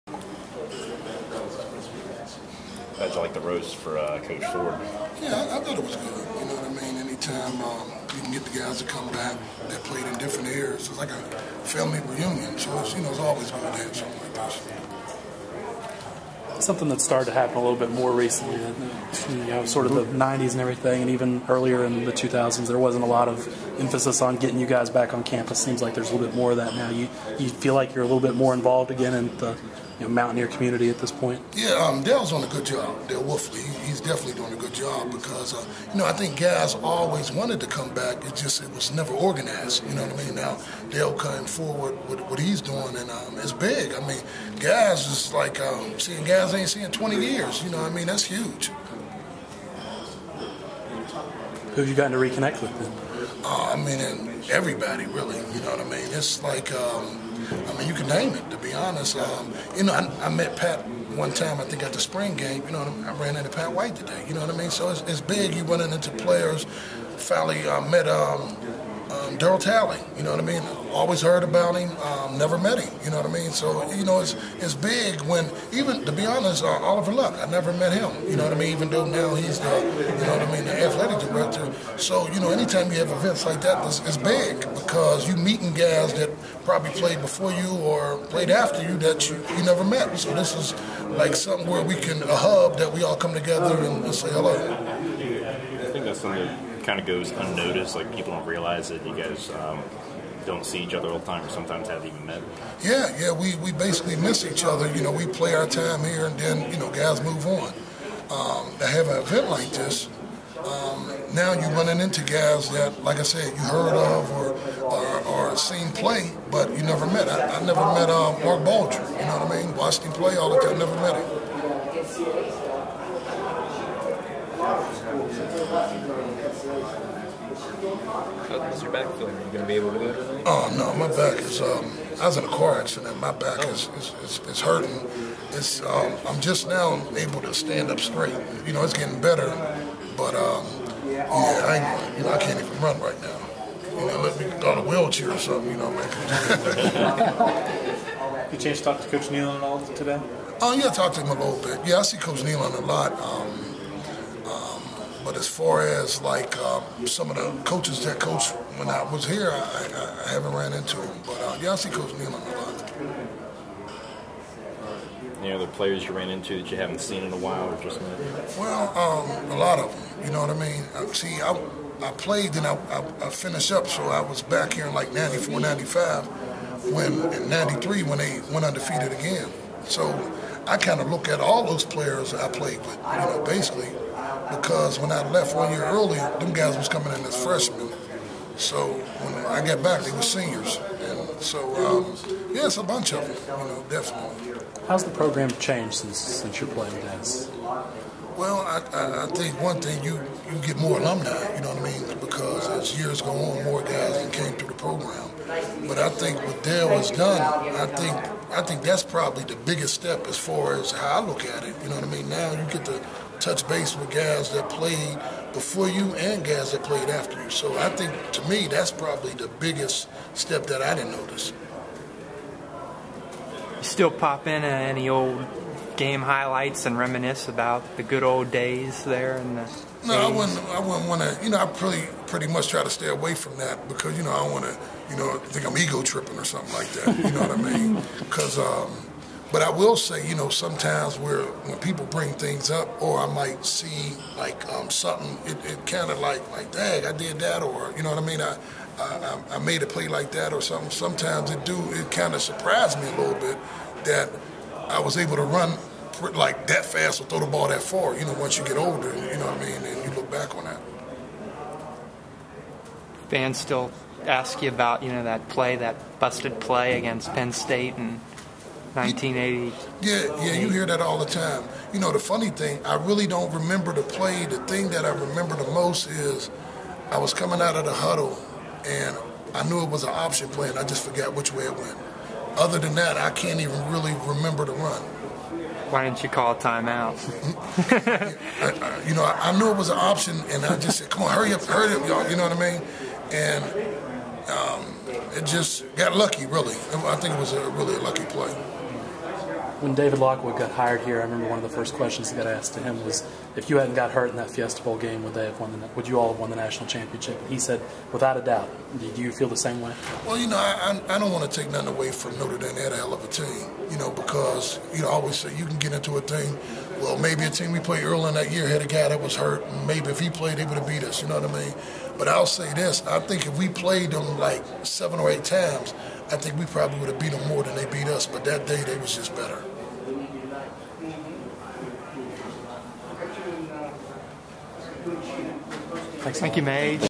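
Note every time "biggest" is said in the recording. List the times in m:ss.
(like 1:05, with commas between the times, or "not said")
3:29, 3:39.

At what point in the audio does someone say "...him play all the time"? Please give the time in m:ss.
2:00.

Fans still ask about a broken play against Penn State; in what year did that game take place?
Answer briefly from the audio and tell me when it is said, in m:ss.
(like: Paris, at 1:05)
1980, at 4:28.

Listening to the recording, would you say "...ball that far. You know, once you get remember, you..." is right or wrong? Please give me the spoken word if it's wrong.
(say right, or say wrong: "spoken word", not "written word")
wrong: "older", not "remember".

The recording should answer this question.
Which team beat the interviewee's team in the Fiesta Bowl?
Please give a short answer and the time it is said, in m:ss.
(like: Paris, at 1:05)
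Notre Dame, at 5:12.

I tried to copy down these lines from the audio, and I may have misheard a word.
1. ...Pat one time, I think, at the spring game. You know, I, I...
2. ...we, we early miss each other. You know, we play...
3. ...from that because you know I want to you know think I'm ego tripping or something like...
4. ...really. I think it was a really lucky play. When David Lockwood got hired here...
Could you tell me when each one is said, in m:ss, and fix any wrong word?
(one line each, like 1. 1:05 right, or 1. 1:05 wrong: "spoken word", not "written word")
1. 1:00 right
2. 1:43 wrong: "basically", not "early"
3. 3:53 right
4. 4:56 right.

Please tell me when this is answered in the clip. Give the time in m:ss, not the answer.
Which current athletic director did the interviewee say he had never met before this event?
1:16.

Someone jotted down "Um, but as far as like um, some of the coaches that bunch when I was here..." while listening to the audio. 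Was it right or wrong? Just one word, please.
wrong.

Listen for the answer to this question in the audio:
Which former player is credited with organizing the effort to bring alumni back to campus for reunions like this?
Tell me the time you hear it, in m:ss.
0:33.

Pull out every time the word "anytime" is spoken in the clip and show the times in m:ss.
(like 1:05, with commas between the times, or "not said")
0:07, 1:22.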